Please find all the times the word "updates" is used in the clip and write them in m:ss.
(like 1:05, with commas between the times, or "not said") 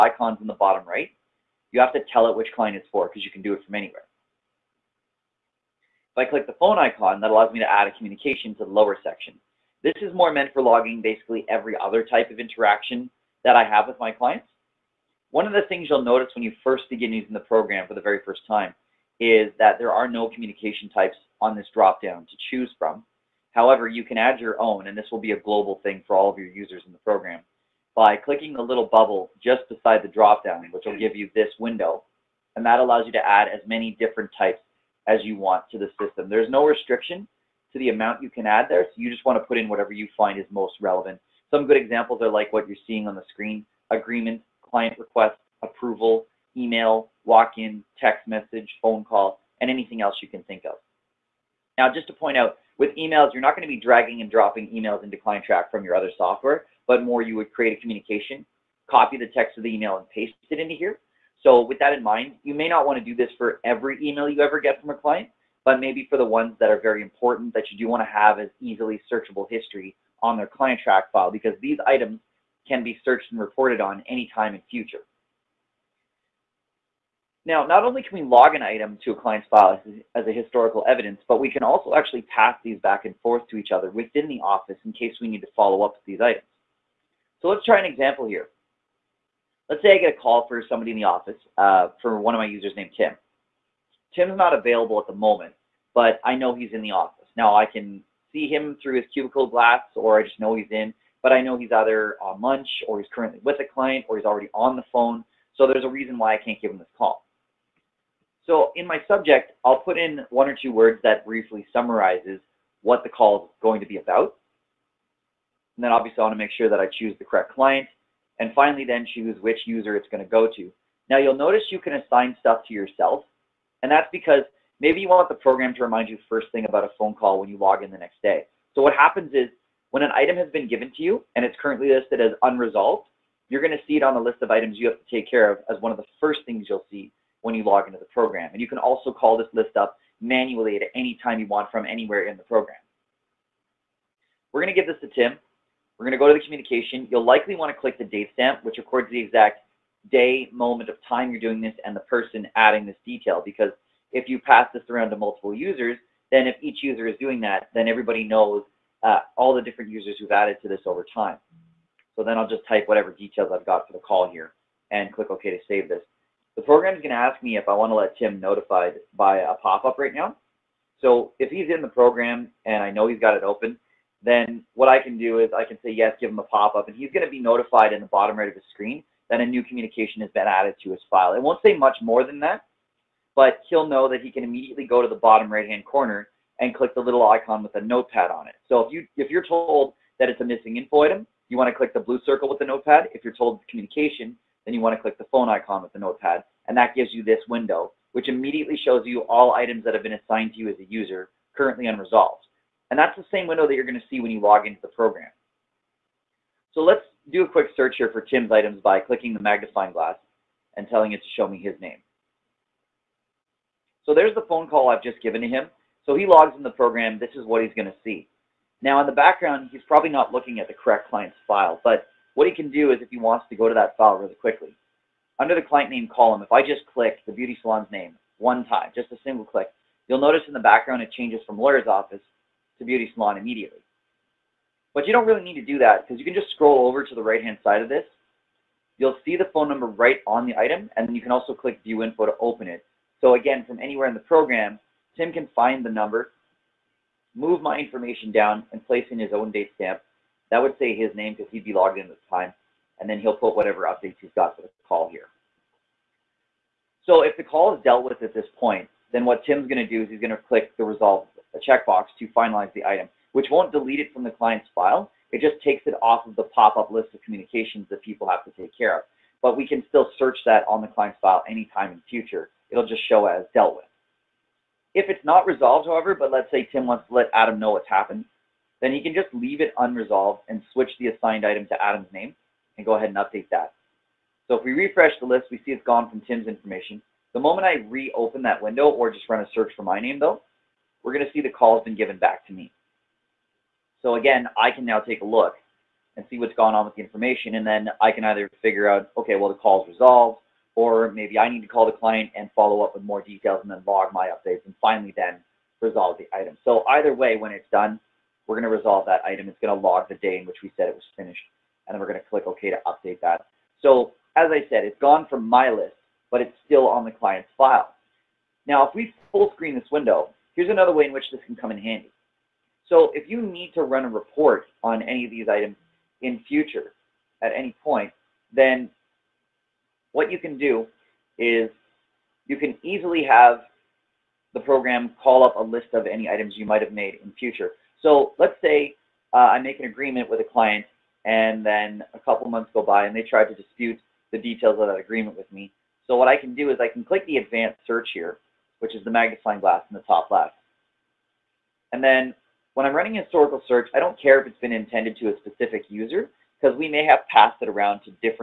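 4:13, 4:43, 5:04, 5:12.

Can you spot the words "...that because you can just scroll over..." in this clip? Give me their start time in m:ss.
3:55.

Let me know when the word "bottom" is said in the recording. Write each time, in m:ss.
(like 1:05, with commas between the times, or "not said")
0:00, 2:58, 3:05.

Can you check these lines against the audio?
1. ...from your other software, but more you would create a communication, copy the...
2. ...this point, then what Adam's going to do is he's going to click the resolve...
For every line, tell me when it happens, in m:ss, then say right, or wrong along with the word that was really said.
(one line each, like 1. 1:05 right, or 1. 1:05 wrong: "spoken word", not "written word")
1. 0:55 right
2. 4:18 wrong: "Tim", not "Adam".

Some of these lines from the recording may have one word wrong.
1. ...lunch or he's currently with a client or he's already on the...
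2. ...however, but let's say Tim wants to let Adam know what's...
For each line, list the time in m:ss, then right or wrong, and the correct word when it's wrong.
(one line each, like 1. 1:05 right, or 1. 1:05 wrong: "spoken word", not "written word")
1. 1:42 right
2. 4:35 right.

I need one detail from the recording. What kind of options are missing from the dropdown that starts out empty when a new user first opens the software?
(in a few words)
Communication types.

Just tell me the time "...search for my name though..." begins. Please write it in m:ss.
4:49.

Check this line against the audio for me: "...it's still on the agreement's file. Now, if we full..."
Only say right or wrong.
wrong.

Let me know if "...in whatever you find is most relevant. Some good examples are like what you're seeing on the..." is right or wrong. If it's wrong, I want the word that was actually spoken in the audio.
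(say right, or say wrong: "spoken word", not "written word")
right.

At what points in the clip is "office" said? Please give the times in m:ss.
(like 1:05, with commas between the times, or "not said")
1:24, 1:31, 1:36, 3:51.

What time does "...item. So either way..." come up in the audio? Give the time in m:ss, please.
5:06.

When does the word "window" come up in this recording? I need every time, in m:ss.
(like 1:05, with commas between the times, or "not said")
0:31, 3:17, 3:23, 4:48, 5:19.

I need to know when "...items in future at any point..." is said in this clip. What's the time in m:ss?
5:25.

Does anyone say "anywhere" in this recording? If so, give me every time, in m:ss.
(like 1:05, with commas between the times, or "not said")
0:03, 2:21, 4:03.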